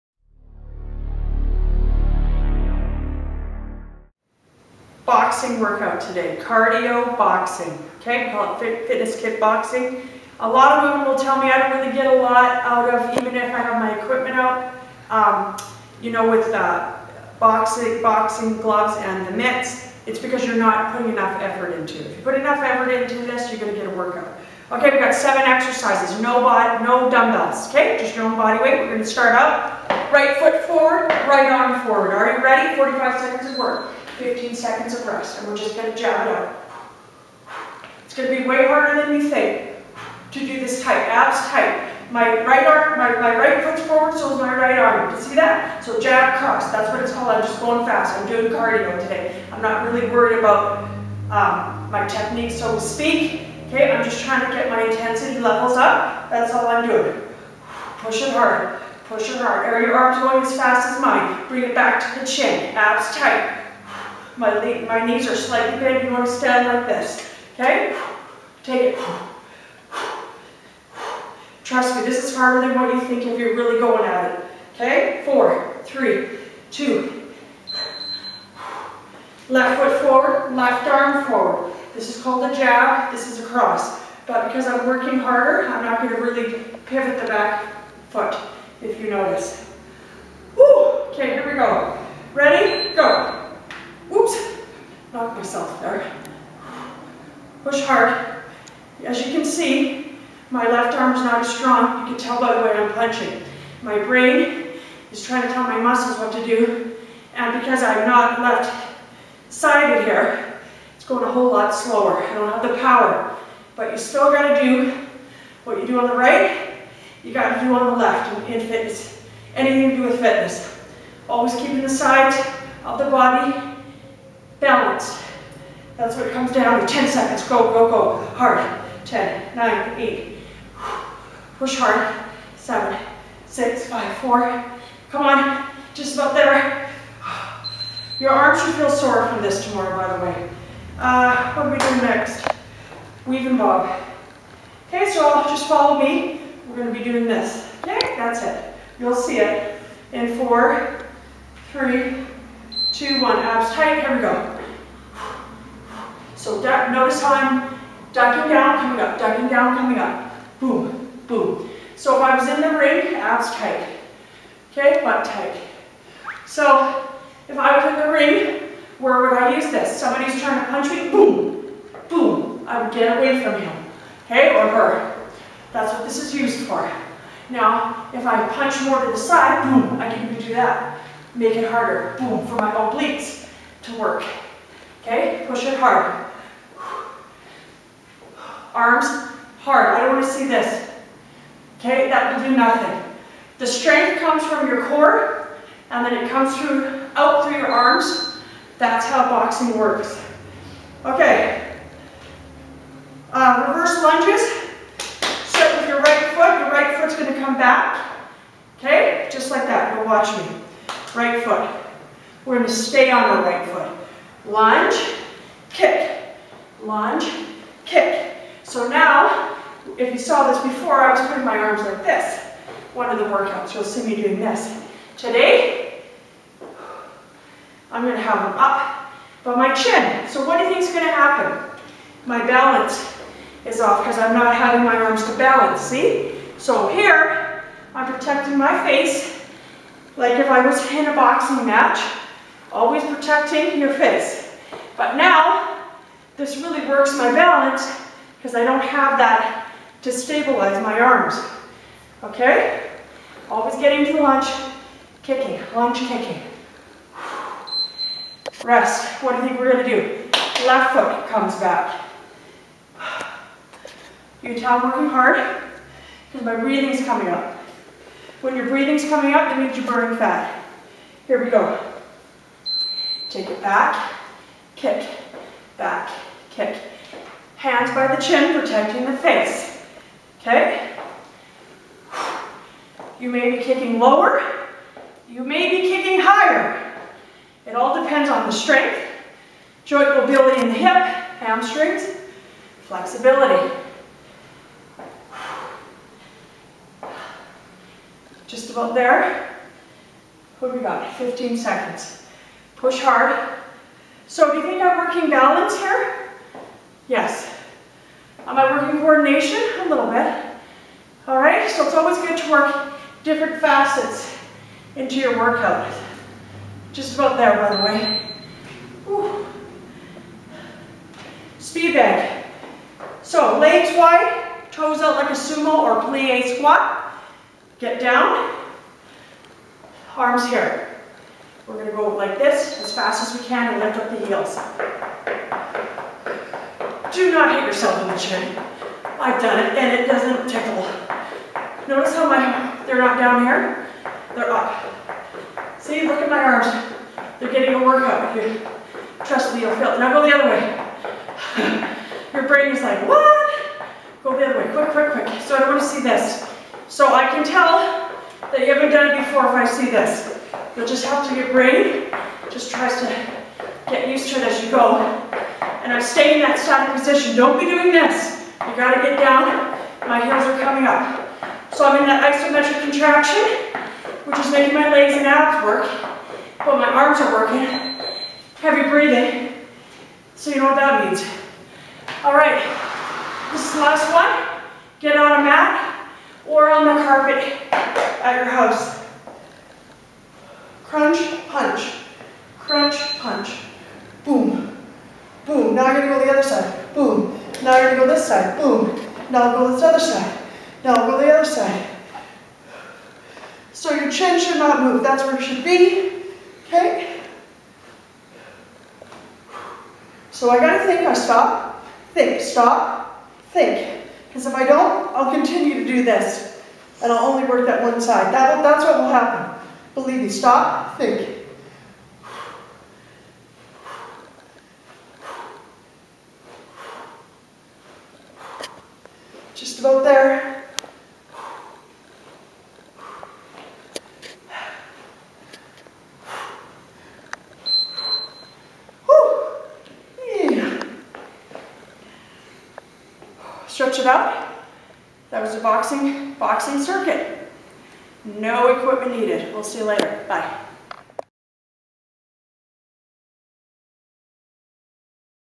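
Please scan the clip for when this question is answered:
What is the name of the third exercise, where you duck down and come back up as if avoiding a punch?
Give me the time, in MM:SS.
02:23.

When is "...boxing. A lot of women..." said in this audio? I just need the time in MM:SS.
00:09.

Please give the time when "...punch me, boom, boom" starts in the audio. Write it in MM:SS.
02:50.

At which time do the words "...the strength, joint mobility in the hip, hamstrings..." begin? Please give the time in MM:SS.
04:48.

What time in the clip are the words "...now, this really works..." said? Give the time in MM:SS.
04:05.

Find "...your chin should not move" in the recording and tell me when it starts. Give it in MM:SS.
06:43.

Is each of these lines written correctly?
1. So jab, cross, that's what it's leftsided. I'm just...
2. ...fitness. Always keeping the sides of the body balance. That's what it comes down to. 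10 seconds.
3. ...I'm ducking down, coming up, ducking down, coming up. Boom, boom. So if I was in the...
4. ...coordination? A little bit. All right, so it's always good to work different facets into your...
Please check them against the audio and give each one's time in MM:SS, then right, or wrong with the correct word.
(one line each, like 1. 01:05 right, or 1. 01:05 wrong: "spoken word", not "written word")
1. 00:45 wrong: "called", not "leftsided"
2. 02:00 right
3. 02:37 right
4. 05:08 right.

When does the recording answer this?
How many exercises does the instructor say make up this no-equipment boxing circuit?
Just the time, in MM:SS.
00:25.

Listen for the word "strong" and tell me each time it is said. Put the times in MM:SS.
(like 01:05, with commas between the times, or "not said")
01:41.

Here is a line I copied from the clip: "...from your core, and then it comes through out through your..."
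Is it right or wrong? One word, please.
right.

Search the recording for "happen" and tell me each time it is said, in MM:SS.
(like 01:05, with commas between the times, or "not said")
03:51, 06:59.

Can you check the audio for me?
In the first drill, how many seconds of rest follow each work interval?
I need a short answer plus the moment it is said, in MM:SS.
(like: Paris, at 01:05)
15 seconds, at 00:34.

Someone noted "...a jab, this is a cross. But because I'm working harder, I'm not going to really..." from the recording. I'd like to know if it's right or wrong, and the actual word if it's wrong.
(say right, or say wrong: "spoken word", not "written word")
right.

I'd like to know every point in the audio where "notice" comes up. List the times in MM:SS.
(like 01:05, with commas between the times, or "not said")
01:29, 02:36, 05:41.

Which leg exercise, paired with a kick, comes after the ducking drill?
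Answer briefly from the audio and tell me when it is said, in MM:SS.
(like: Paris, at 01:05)
Reverse lunges, at 03:23.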